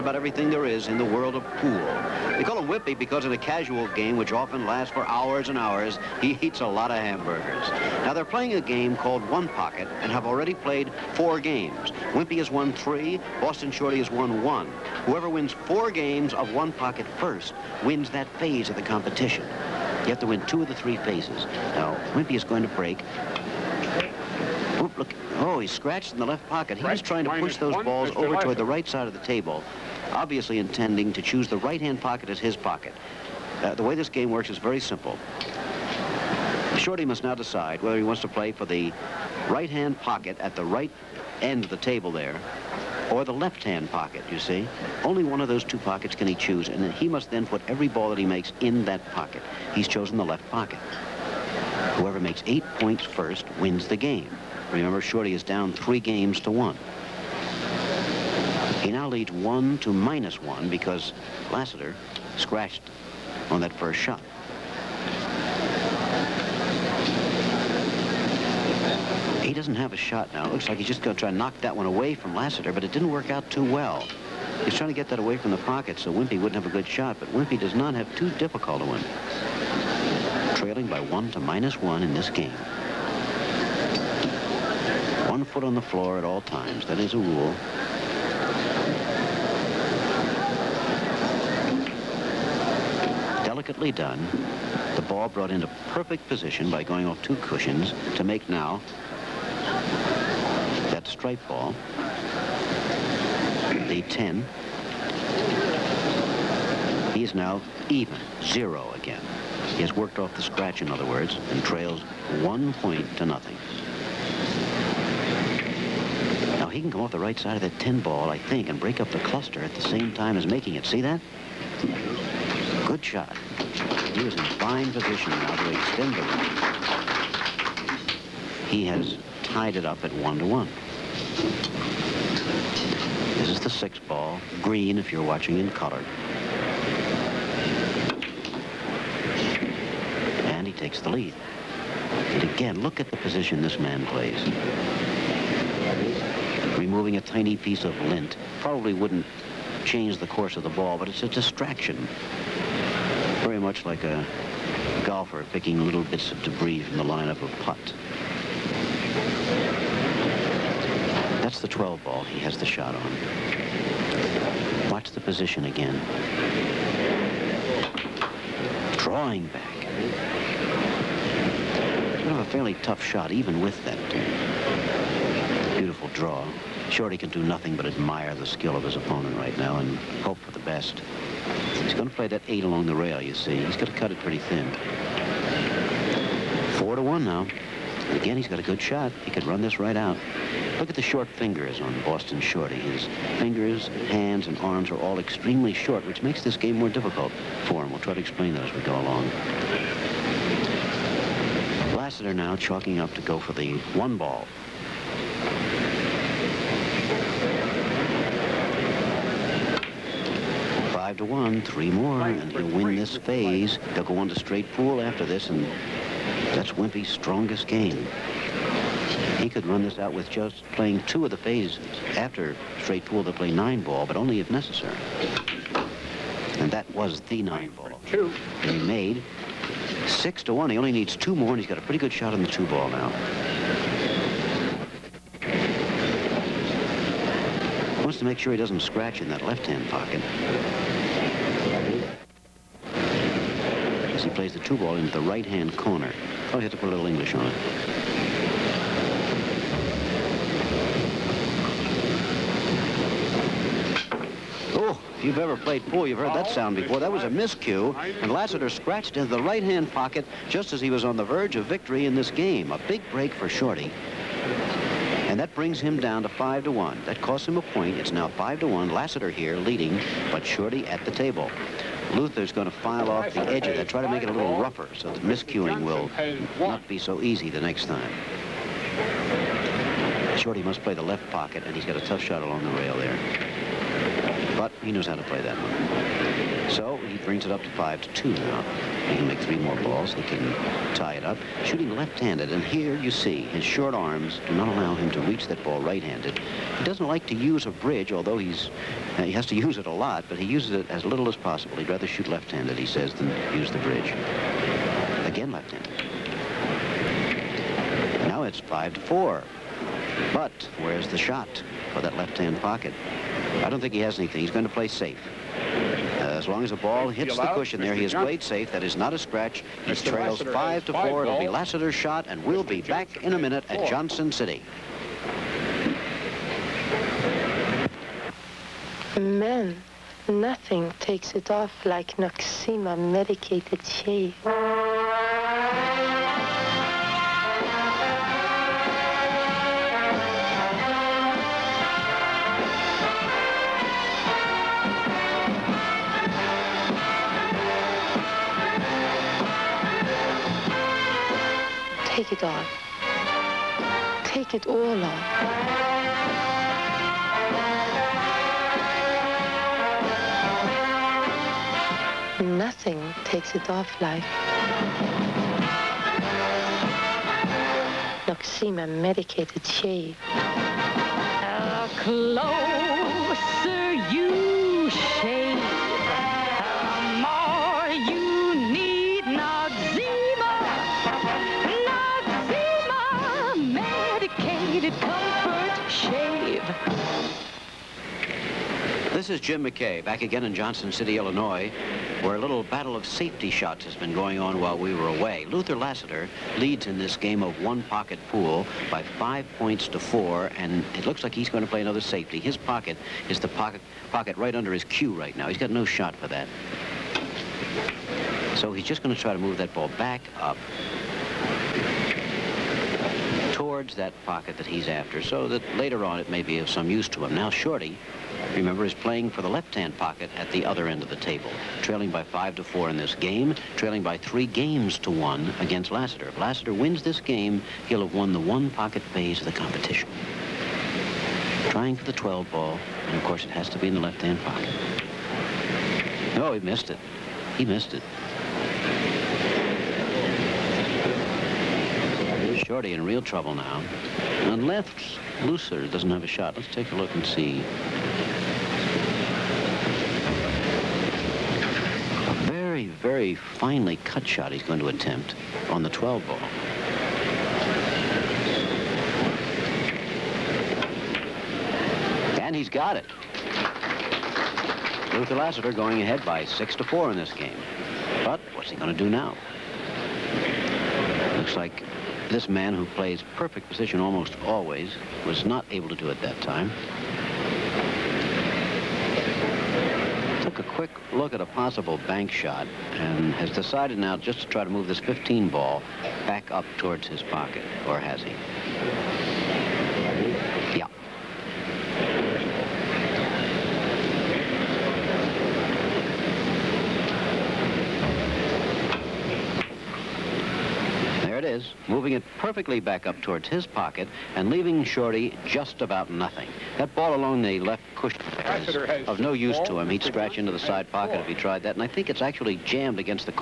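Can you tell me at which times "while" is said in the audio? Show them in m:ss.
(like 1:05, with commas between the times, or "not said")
6:34.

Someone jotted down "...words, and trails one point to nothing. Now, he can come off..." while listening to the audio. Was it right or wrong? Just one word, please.
right.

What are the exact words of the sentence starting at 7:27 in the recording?
A very, very finely cut shot he's going to attempt on the 12 ball.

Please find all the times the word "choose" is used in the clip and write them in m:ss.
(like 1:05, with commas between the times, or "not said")
0:31, 0:46.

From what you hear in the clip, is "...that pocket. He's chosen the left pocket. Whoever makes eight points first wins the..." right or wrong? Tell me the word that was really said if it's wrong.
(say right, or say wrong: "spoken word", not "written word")
right.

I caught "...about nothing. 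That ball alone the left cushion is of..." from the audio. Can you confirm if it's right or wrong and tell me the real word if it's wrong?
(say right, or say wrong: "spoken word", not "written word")
right.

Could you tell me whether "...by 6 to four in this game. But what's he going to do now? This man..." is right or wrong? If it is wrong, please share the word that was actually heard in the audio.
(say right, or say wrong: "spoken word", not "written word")
right.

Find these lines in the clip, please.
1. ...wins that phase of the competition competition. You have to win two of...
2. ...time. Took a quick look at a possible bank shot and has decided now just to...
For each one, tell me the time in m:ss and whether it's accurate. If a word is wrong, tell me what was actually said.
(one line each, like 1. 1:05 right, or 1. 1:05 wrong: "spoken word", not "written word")
1. 0:17 right
2. 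7:56 right.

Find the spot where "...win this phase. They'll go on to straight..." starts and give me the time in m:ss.
3:32.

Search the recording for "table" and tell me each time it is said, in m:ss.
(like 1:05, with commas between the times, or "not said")
0:29, 0:41, 4:31, 7:01.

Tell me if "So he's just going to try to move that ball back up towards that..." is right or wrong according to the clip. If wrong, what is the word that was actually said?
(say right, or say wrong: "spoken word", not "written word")
right.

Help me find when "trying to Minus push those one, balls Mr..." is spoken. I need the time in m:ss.
0:27.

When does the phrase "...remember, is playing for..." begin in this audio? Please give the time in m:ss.
6:58.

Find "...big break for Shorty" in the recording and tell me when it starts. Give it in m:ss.
4:22.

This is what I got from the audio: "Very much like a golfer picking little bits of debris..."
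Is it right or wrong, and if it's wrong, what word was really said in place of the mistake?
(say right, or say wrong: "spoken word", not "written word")
right.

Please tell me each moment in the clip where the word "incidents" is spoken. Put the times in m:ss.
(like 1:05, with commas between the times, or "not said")
not said.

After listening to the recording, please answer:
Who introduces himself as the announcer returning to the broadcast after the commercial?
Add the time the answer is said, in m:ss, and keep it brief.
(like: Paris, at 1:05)
Jim McKay, at 6:29.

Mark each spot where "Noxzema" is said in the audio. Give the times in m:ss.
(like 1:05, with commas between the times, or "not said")
5:32, 6:08.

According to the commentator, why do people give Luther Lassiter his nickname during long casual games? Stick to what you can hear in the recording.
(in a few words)
He eats a lot of hamburgers.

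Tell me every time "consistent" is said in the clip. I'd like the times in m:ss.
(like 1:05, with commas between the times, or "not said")
not said.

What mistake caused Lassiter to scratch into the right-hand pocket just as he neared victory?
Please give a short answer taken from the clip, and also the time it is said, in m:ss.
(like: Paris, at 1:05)
A miscue, at 4:17.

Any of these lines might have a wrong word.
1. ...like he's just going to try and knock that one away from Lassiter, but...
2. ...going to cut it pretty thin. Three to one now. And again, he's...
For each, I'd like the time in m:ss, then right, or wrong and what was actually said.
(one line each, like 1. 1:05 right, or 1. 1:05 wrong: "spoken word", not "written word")
1. 1:10 right
2. 3:03 wrong: "Four", not "Three".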